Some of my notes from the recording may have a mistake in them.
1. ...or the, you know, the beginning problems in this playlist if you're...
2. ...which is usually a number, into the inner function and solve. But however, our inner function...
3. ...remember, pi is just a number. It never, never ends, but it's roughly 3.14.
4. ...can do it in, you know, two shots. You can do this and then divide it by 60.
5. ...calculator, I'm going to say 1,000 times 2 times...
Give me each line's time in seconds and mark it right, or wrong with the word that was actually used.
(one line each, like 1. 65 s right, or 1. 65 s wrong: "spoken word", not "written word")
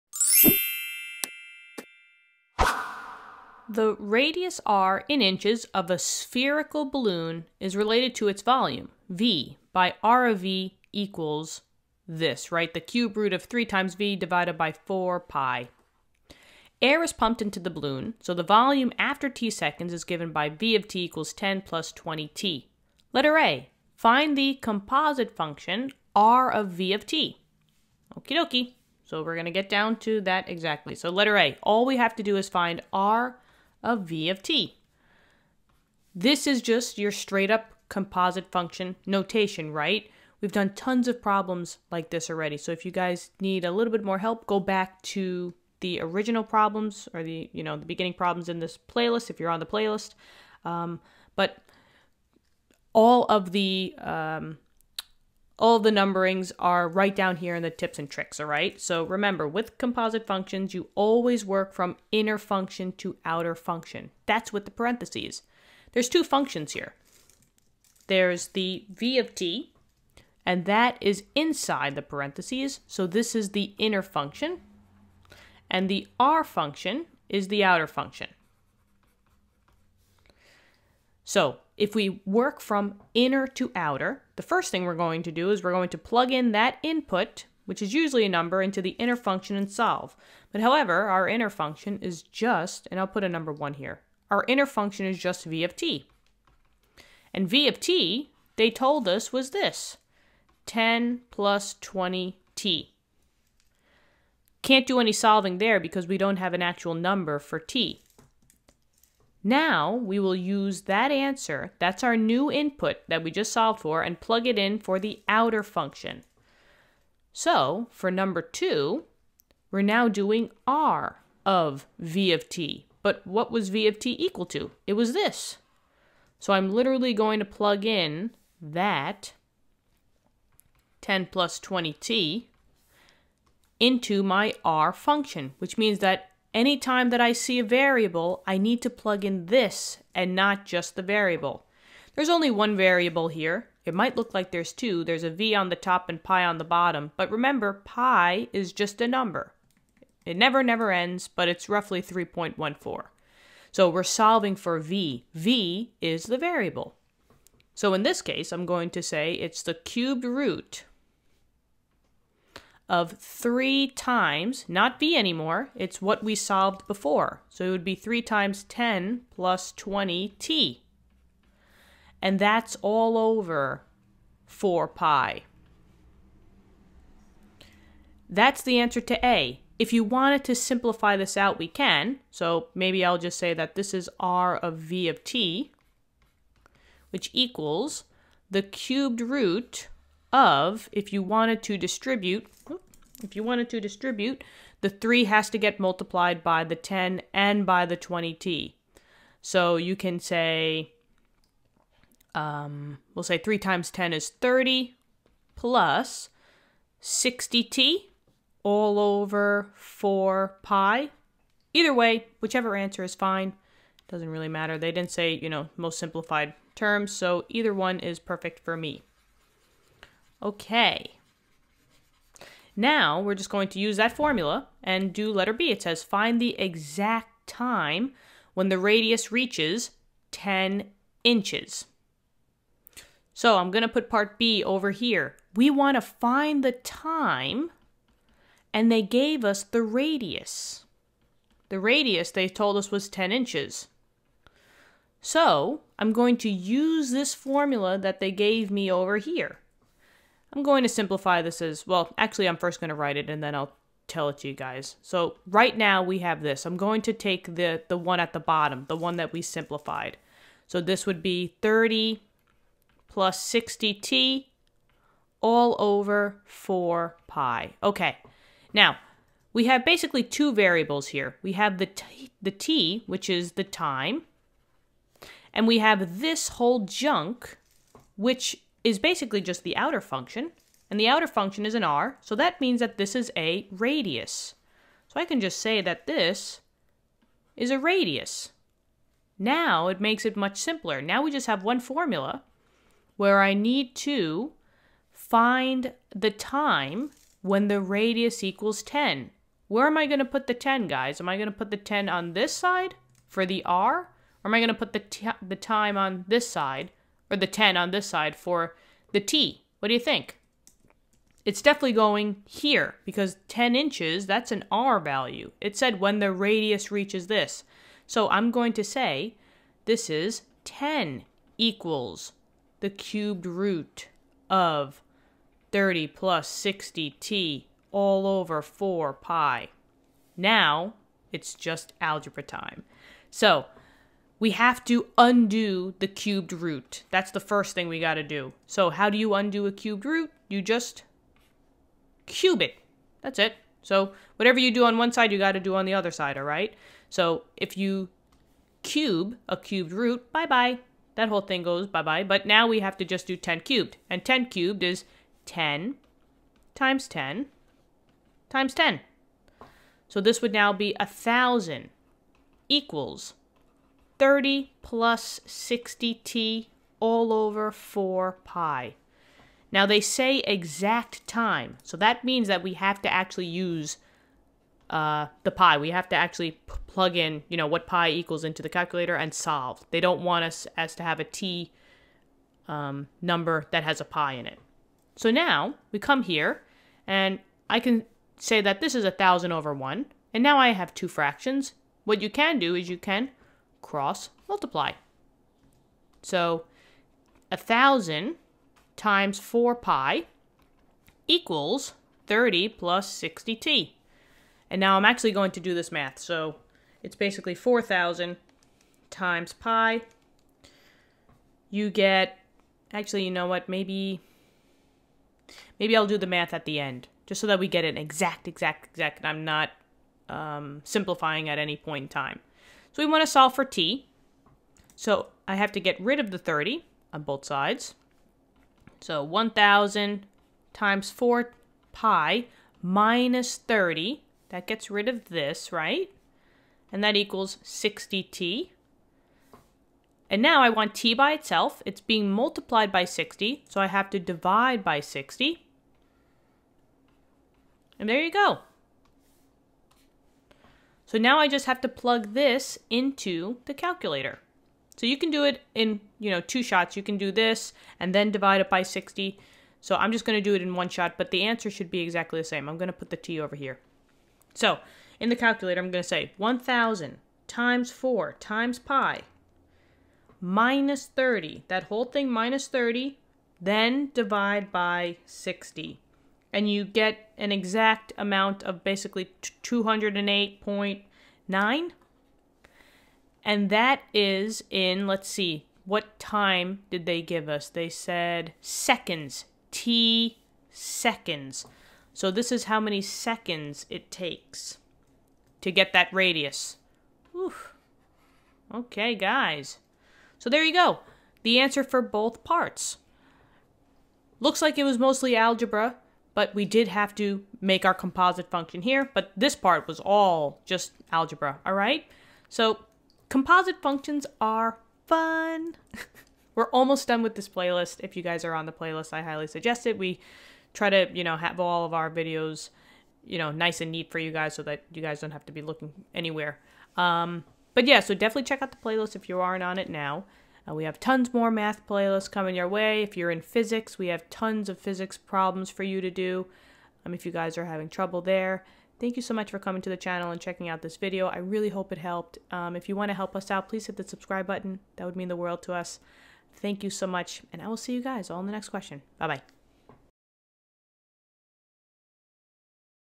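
1. 47 s right
2. 87 s right
3. 147 s right
4. 455 s right
5. 465 s wrong: "4", not "2".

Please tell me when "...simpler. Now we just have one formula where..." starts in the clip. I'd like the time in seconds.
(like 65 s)
290 s.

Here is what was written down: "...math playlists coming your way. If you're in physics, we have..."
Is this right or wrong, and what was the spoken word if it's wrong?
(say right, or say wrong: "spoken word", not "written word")
right.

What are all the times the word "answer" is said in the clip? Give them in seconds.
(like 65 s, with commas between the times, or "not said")
111 s, 178 s, 212 s, 461 s, 501 s.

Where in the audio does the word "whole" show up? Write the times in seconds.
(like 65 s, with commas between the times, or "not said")
276 s, 351 s, 471 s.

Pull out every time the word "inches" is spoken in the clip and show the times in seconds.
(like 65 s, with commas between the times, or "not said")
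5 s, 231 s, 243 s, 313 s.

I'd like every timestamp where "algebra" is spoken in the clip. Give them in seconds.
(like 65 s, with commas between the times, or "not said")
332 s, 505 s, 511 s.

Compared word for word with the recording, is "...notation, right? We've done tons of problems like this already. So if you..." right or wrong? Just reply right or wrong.
right.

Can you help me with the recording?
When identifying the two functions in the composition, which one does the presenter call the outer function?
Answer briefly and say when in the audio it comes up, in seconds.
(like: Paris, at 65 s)
the r function, at 75 s.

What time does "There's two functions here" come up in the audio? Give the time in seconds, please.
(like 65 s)
65 s.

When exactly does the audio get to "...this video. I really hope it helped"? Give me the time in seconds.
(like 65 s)
540 s.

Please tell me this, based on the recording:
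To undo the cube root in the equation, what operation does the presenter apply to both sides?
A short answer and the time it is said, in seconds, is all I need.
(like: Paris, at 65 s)
cube it, at 340 s.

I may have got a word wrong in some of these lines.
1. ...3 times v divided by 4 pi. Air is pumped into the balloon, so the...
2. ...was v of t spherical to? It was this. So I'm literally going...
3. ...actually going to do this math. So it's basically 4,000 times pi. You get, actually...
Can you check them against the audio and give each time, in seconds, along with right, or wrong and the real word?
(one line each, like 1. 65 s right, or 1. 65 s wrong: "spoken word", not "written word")
1. 13 s right
2. 123 s wrong: "equal", not "spherical"
3. 405 s right.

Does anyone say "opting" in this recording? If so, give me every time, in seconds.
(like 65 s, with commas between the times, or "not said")
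not said.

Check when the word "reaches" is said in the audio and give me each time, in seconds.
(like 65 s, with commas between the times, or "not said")
229 s, 316 s.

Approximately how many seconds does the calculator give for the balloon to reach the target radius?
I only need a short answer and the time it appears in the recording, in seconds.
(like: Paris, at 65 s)
208.9, at 479 s.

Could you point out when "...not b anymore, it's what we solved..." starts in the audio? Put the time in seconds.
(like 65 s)
164 s.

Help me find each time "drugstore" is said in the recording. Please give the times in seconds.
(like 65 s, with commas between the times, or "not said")
not said.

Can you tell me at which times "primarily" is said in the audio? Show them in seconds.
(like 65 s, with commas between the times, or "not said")
not said.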